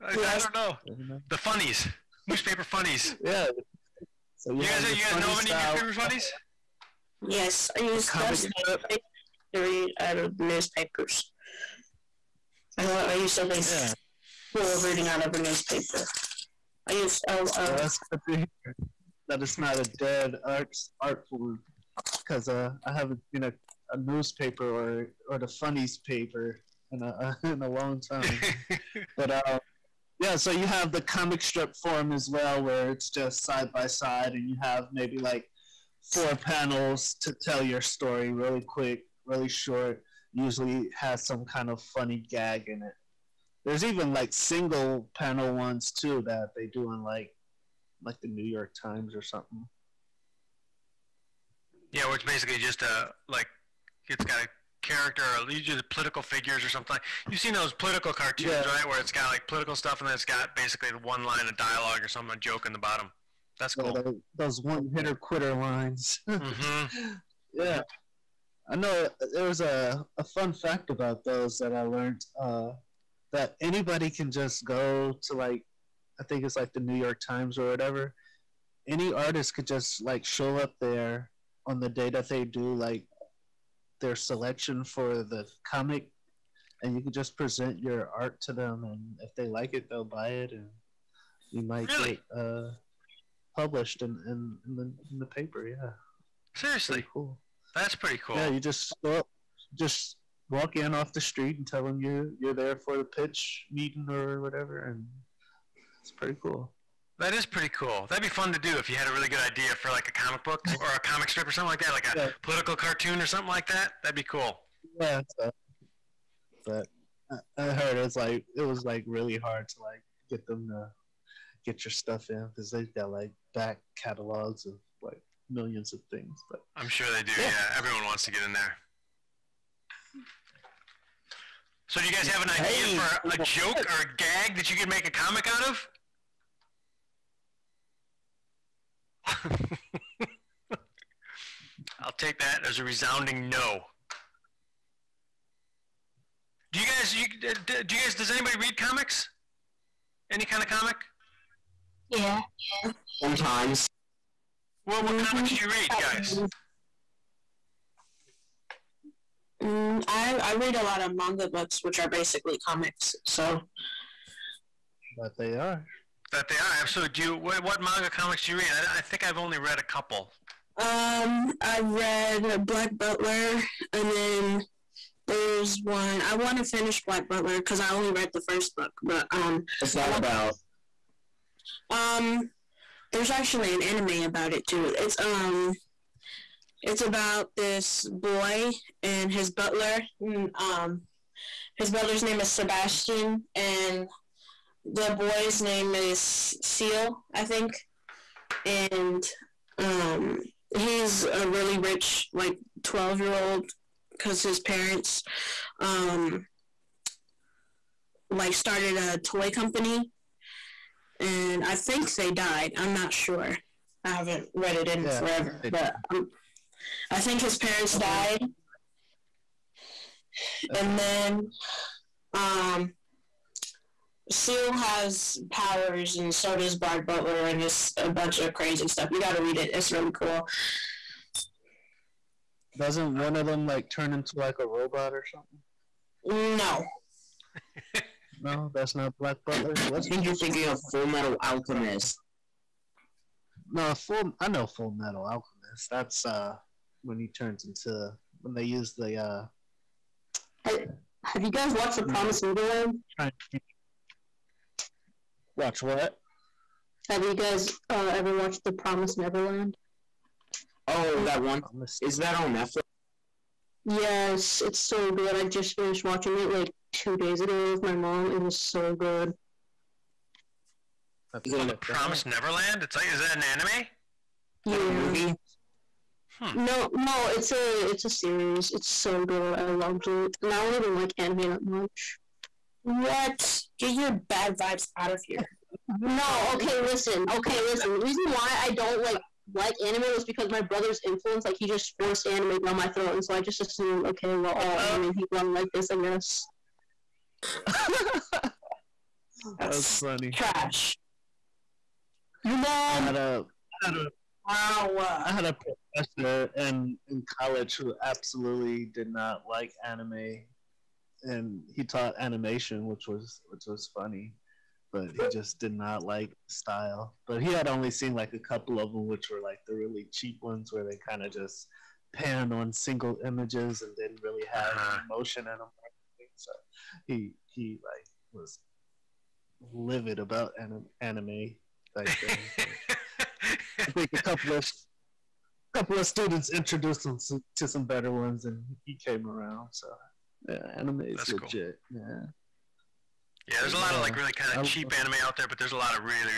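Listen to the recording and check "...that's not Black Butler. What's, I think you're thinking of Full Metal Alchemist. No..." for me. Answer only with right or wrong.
right.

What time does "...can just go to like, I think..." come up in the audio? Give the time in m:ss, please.
1:14.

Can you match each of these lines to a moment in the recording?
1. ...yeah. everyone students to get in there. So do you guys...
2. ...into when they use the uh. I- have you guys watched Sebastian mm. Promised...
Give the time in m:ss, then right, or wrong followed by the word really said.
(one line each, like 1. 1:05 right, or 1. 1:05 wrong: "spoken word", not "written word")
1. 2:07 wrong: "wants", not "students"
2. 4:07 wrong: "The", not "Sebastian".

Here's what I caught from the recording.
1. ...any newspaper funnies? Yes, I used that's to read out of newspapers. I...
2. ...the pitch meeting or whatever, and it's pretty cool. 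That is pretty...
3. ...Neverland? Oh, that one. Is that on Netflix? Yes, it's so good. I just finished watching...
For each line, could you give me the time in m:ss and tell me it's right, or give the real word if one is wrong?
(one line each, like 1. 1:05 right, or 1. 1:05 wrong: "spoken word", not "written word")
1. 0:05 right
2. 1:42 right
3. 4:19 right.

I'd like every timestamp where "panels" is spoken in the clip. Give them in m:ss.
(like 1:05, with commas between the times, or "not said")
0:36, 0:45.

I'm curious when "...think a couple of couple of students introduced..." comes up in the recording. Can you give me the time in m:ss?
5:33.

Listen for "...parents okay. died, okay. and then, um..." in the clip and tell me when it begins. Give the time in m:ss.
3:37.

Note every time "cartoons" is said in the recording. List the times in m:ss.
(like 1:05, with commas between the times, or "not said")
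0:58, 1:52.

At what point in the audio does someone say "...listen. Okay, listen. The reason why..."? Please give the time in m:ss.
4:46.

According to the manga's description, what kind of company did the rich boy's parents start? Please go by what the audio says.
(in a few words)
toy company.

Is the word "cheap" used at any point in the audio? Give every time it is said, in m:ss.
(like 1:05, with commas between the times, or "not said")
5:20, 5:44.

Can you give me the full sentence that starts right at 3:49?
You got to read it; it's really cool.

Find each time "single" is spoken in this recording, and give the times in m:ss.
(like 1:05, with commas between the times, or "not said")
0:44, 5:22.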